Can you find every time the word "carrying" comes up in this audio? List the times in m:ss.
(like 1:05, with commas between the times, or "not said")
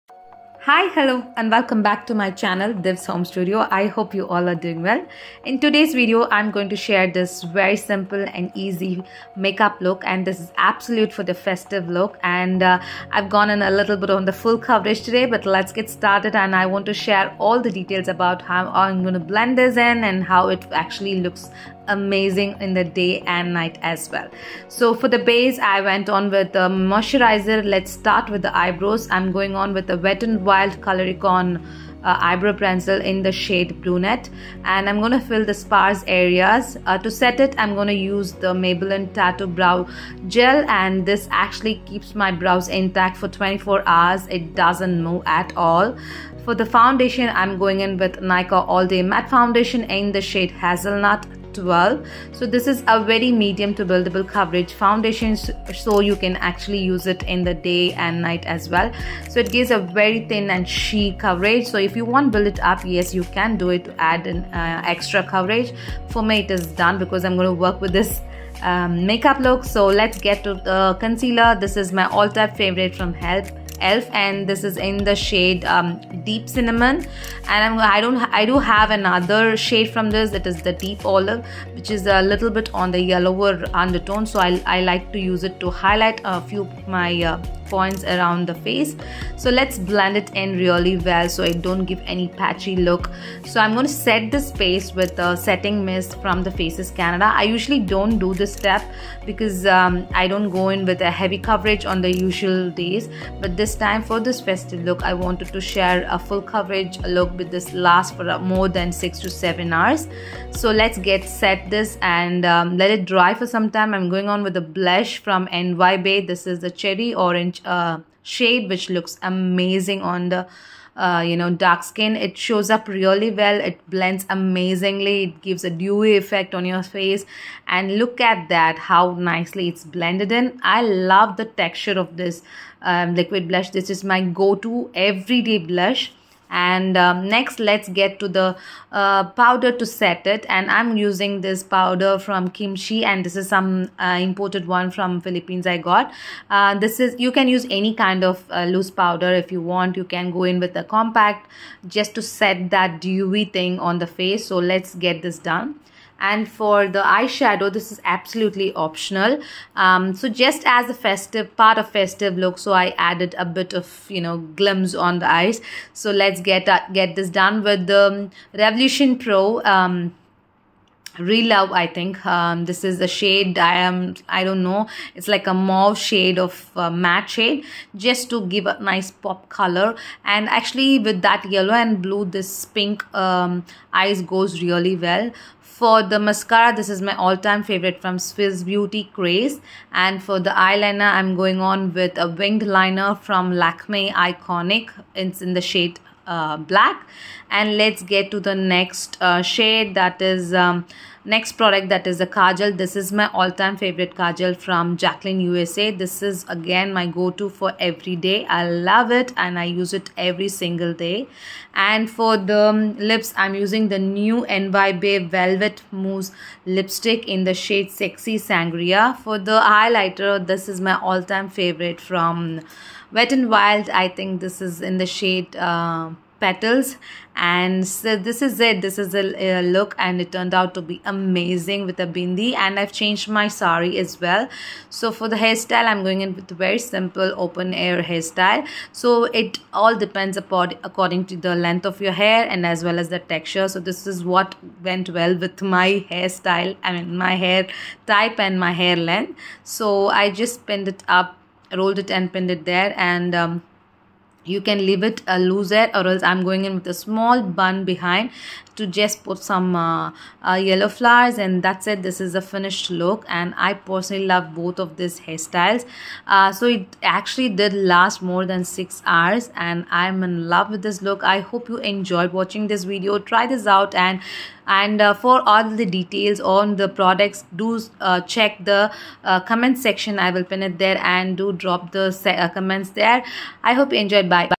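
not said.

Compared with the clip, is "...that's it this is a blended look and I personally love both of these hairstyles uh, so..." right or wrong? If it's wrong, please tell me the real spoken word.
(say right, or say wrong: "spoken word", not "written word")
wrong: "finished", not "blended".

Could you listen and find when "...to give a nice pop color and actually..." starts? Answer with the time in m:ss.
2:58.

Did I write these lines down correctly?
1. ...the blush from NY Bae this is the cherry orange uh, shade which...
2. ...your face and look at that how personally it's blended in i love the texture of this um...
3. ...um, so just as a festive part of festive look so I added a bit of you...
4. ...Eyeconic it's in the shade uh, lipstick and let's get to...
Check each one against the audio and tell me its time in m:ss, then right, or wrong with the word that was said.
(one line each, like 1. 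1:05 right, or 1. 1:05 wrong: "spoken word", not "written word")
1. 1:54 right
2. 2:06 wrong: "nicely", not "personally"
3. 2:39 right
4. 3:14 wrong: "black", not "lipstick".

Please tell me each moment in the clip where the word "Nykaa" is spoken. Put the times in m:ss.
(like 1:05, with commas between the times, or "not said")
0:48.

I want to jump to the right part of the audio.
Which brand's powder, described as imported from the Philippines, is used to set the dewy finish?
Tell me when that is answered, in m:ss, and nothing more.
2:22.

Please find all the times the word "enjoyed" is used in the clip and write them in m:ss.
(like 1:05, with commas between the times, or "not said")
4:31, 4:44.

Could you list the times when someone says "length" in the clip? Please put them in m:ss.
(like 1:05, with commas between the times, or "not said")
4:01, 4:08.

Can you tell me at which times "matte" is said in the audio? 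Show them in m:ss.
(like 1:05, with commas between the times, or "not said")
0:49, 2:56.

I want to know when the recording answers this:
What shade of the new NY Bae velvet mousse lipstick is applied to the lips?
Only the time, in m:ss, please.
3:37.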